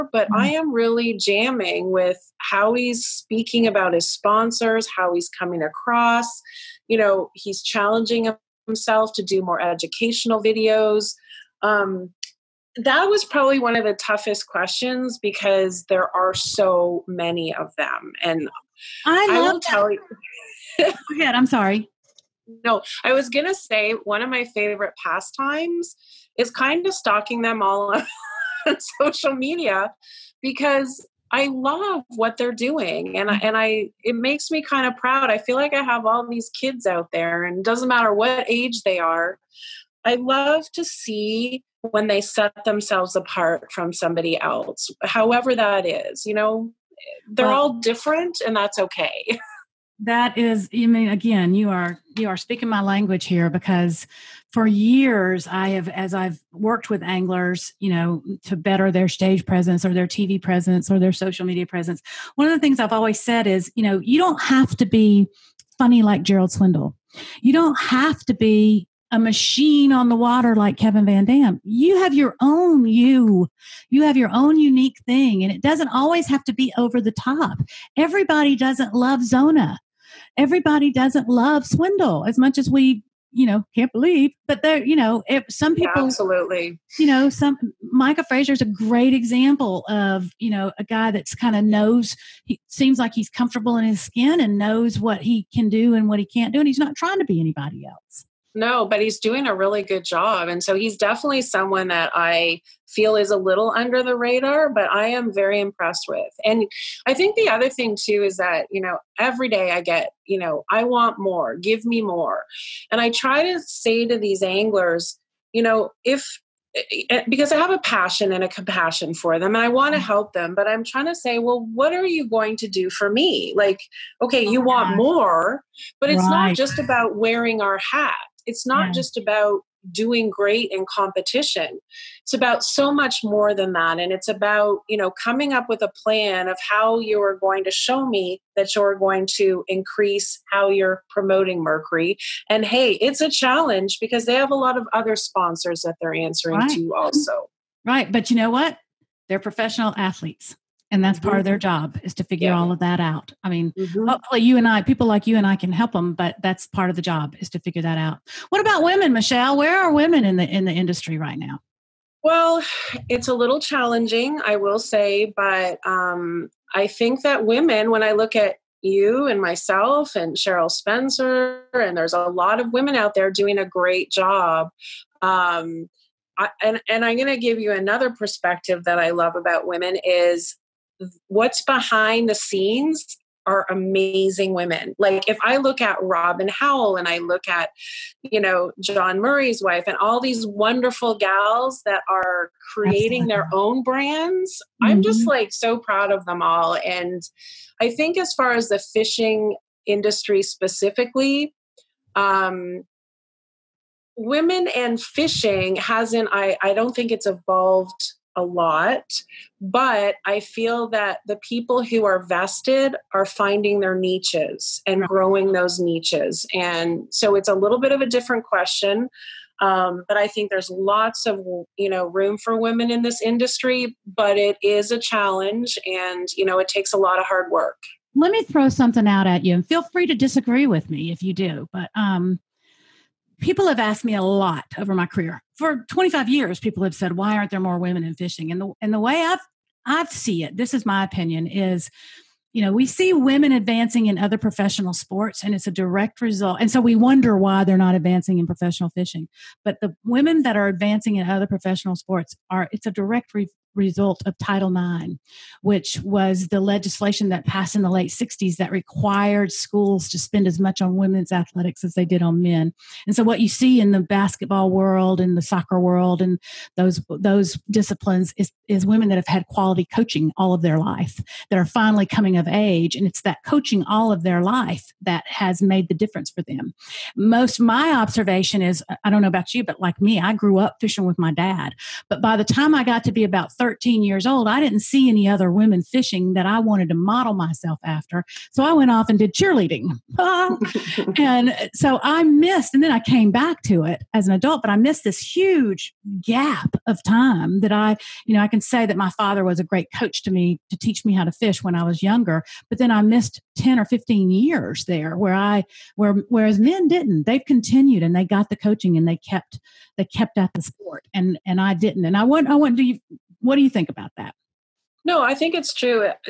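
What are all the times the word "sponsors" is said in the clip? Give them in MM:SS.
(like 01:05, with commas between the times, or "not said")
00:04, 02:25.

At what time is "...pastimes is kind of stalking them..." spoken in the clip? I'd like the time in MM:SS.
00:25.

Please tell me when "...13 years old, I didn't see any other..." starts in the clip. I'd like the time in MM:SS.
04:43.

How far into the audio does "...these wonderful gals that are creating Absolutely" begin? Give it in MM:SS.
03:10.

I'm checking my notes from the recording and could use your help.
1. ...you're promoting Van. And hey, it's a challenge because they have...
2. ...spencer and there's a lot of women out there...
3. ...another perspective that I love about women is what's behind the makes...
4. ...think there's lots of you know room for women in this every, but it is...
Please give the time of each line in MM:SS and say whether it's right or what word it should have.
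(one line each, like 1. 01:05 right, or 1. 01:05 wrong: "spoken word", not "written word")
1. 02:20 wrong: "Mercury", not "Van"
2. 02:50 right
3. 02:57 wrong: "scenes", not "makes"
4. 03:40 wrong: "industry", not "every".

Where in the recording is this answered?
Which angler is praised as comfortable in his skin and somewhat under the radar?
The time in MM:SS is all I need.
01:27.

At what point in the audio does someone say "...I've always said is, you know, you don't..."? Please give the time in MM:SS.
01:02.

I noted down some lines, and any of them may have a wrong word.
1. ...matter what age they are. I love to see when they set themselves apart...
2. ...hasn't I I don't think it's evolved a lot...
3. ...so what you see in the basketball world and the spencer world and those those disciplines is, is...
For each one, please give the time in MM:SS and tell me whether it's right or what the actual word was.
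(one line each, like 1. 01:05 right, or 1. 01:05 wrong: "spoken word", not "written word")
1. 00:37 right
2. 03:25 right
3. 04:23 wrong: "soccer", not "spencer".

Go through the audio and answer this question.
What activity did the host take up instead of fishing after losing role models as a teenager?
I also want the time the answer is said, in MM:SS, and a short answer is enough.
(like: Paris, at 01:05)
Cheerleading, at 04:49.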